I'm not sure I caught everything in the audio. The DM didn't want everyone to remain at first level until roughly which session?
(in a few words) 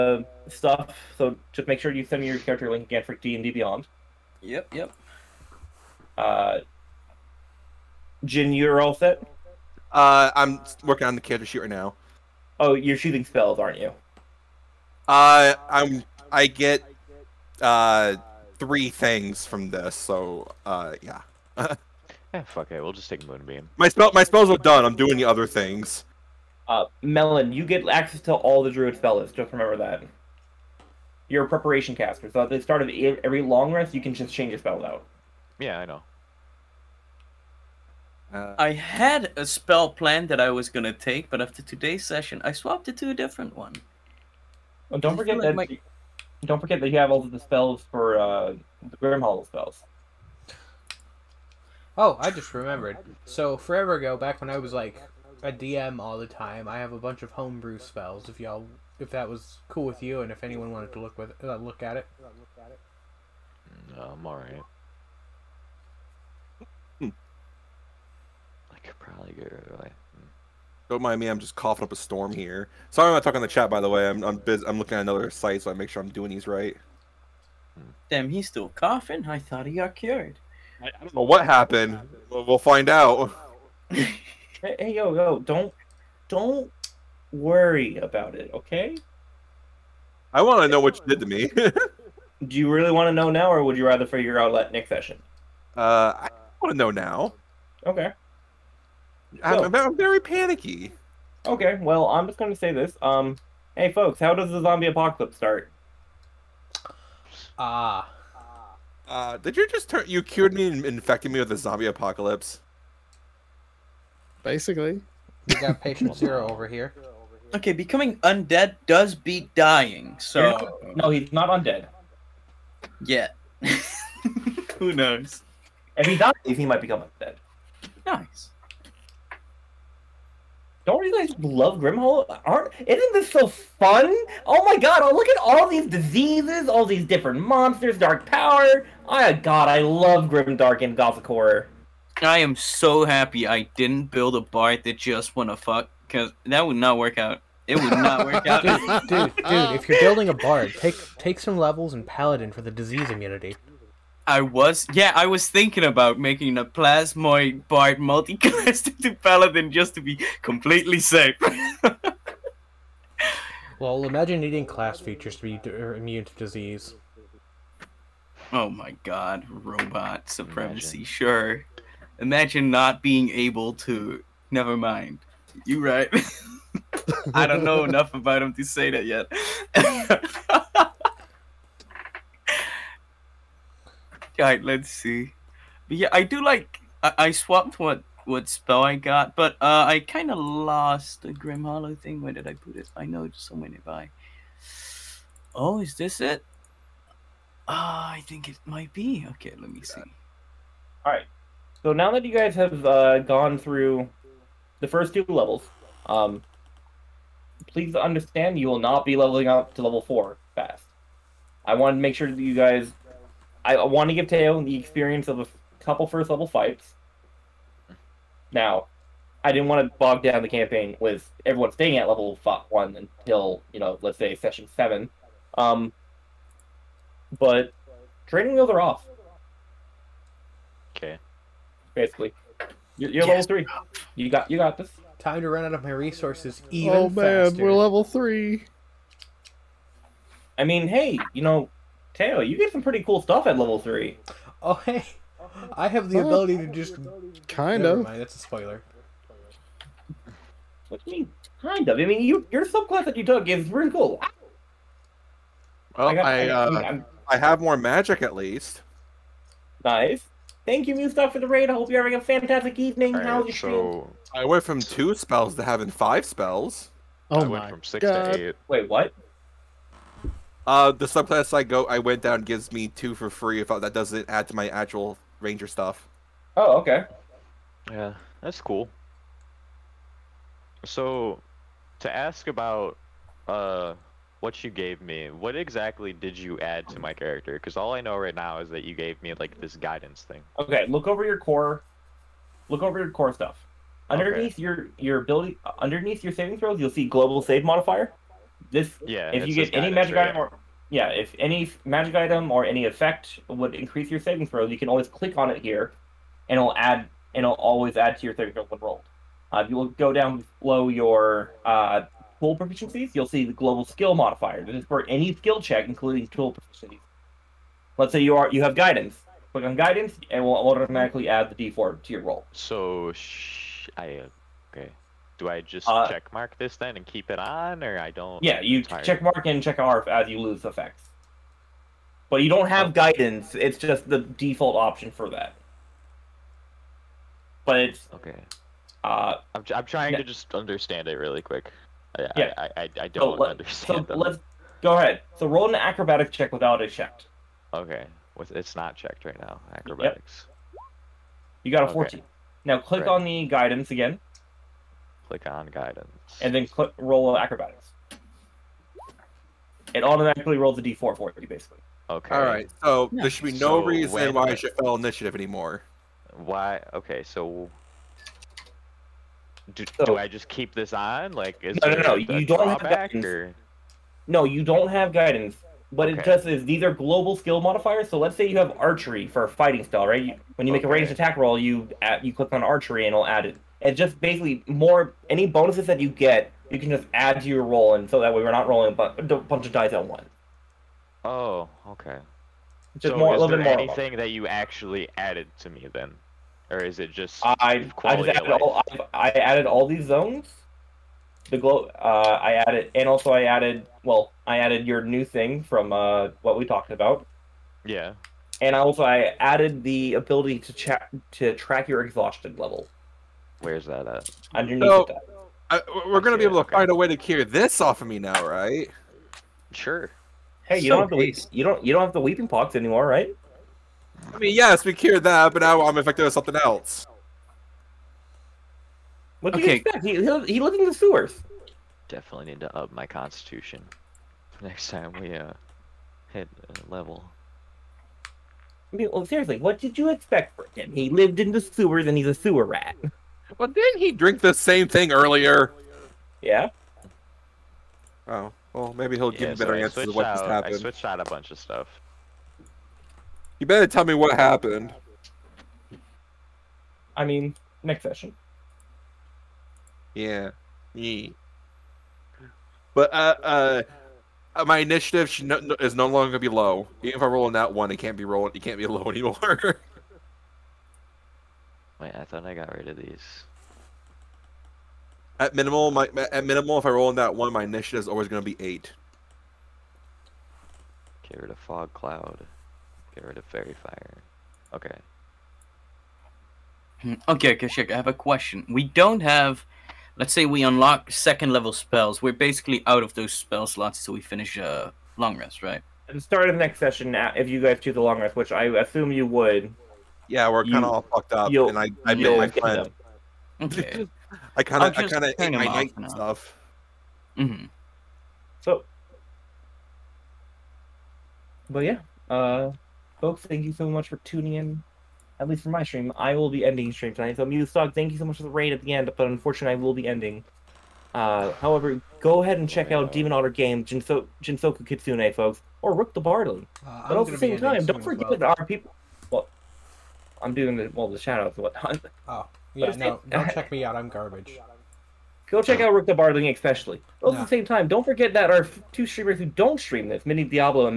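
Session 7.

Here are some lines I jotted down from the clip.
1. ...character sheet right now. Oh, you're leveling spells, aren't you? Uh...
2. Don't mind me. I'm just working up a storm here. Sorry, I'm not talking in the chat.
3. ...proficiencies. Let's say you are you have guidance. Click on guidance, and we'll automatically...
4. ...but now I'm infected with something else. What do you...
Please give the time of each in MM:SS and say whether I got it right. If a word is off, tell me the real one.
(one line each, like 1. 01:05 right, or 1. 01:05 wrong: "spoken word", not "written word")
1. 00:11 wrong: "shooting", not "leveling"
2. 01:10 wrong: "coughing", not "working"
3. 05:16 right
4. 07:05 right.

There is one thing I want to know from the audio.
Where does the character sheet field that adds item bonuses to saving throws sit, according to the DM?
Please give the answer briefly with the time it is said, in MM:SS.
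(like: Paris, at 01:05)
Global save modifier, at 04:57.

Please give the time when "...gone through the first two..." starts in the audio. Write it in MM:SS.
03:23.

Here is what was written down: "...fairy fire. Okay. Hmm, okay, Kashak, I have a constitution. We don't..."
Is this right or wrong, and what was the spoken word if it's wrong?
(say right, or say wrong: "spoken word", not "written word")
wrong: "question", not "constitution".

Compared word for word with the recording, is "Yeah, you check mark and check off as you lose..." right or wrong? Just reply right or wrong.
right.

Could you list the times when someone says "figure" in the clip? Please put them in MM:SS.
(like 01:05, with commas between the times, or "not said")
01:34.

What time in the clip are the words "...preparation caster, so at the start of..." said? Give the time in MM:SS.
00:31.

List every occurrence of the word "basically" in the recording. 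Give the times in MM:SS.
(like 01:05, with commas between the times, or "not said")
01:54, 03:51, 06:01, 06:24, 08:12.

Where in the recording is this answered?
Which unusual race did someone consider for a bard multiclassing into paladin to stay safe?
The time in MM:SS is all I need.
02:36.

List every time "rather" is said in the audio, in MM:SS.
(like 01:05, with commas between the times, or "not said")
01:33.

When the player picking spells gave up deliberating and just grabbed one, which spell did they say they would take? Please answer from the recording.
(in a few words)
Moonbeam.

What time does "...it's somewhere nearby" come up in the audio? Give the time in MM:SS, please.
03:13.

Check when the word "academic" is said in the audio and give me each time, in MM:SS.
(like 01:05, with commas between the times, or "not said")
not said.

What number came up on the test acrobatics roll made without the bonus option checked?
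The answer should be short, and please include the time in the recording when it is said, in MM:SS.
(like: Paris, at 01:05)
14, at 05:51.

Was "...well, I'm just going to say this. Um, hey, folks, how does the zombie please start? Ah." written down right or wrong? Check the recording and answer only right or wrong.
wrong.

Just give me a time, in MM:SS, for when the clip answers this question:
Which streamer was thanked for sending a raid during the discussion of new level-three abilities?
04:20.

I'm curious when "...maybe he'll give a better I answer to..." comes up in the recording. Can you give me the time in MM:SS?
07:28.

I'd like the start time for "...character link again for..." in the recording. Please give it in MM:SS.
00:02.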